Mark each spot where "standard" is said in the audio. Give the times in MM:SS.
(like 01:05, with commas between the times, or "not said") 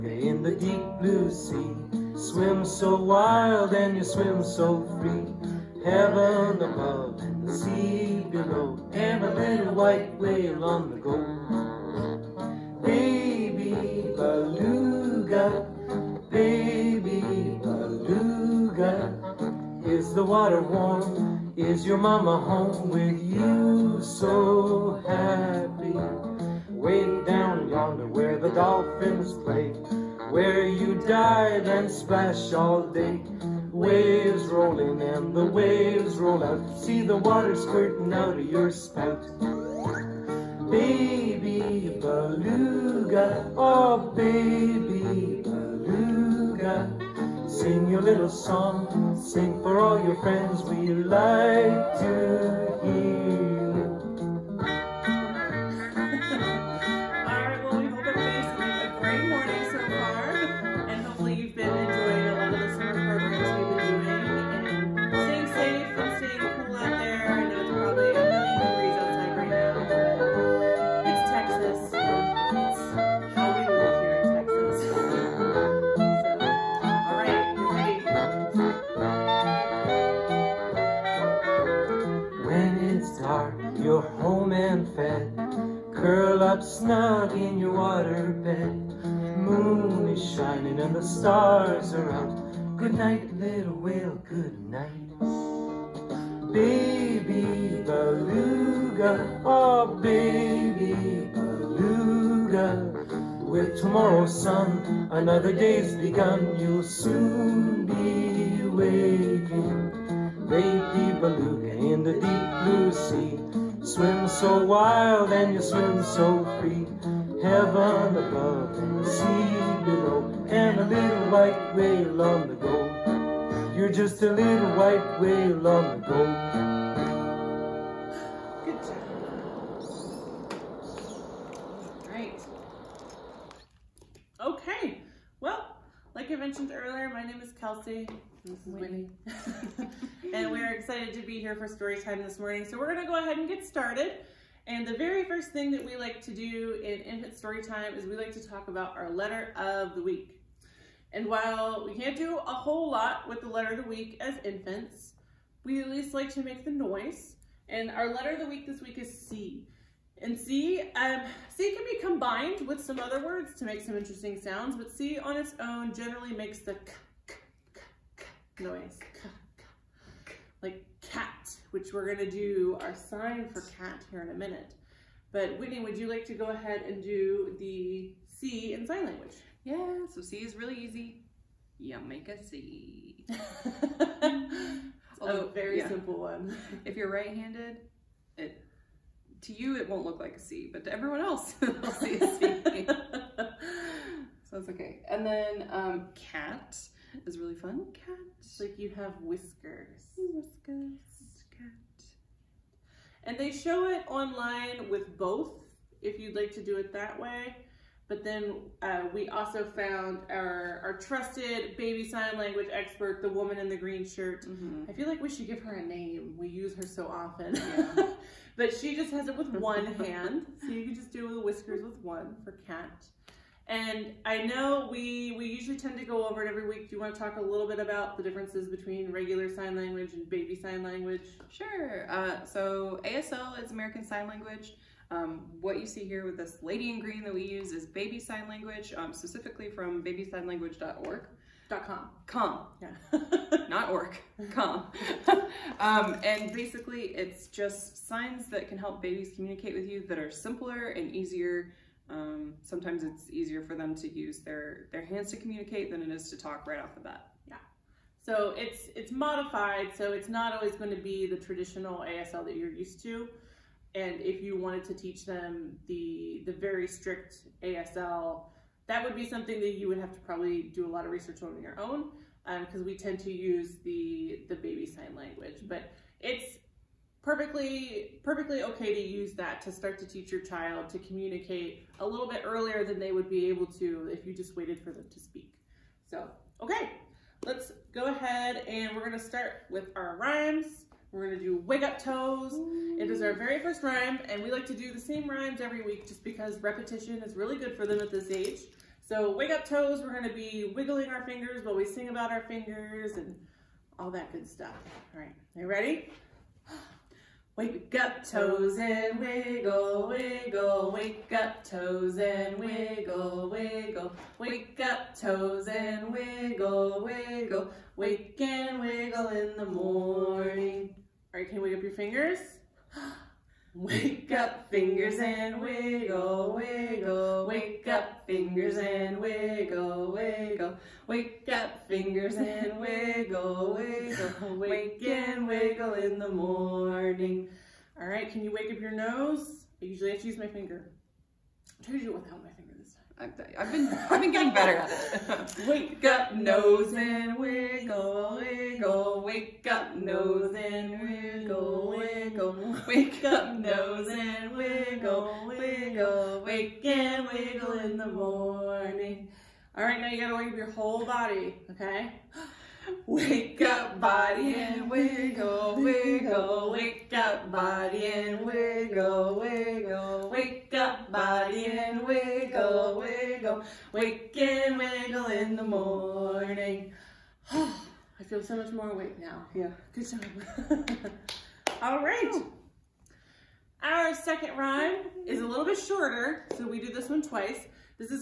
not said.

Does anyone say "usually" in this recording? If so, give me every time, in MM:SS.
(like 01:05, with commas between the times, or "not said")
03:45, 05:39.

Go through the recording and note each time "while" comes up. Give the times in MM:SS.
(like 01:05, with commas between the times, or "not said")
02:31, 05:01.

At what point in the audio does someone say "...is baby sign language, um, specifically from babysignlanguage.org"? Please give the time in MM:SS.
03:57.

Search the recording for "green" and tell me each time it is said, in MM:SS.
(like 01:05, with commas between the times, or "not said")
03:33, 03:56.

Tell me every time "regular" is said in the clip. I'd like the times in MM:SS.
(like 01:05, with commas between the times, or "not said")
03:49.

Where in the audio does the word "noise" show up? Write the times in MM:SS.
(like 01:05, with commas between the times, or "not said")
02:36, 02:48.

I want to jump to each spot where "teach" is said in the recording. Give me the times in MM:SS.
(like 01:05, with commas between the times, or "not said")
04:24, 04:40.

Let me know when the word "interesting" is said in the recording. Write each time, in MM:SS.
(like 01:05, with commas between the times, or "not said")
02:43.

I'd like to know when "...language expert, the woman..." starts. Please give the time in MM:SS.
03:32.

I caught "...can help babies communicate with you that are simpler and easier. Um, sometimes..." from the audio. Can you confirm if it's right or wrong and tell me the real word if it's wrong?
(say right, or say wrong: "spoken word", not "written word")
right.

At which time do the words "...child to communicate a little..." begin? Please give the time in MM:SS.
04:40.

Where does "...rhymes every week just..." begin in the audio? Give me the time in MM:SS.
04:55.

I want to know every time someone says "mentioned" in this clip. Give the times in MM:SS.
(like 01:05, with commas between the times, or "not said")
02:16.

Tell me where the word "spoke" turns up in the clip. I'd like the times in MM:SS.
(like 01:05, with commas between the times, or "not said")
not said.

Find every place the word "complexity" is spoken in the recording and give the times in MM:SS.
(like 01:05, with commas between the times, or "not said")
not said.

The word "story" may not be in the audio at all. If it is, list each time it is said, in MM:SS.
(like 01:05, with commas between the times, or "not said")
02:21, 02:27.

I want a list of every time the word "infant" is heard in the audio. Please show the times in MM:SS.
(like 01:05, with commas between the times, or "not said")
02:27, 02:34.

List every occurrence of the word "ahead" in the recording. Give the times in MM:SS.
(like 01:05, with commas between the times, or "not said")
02:23, 02:56, 04:48.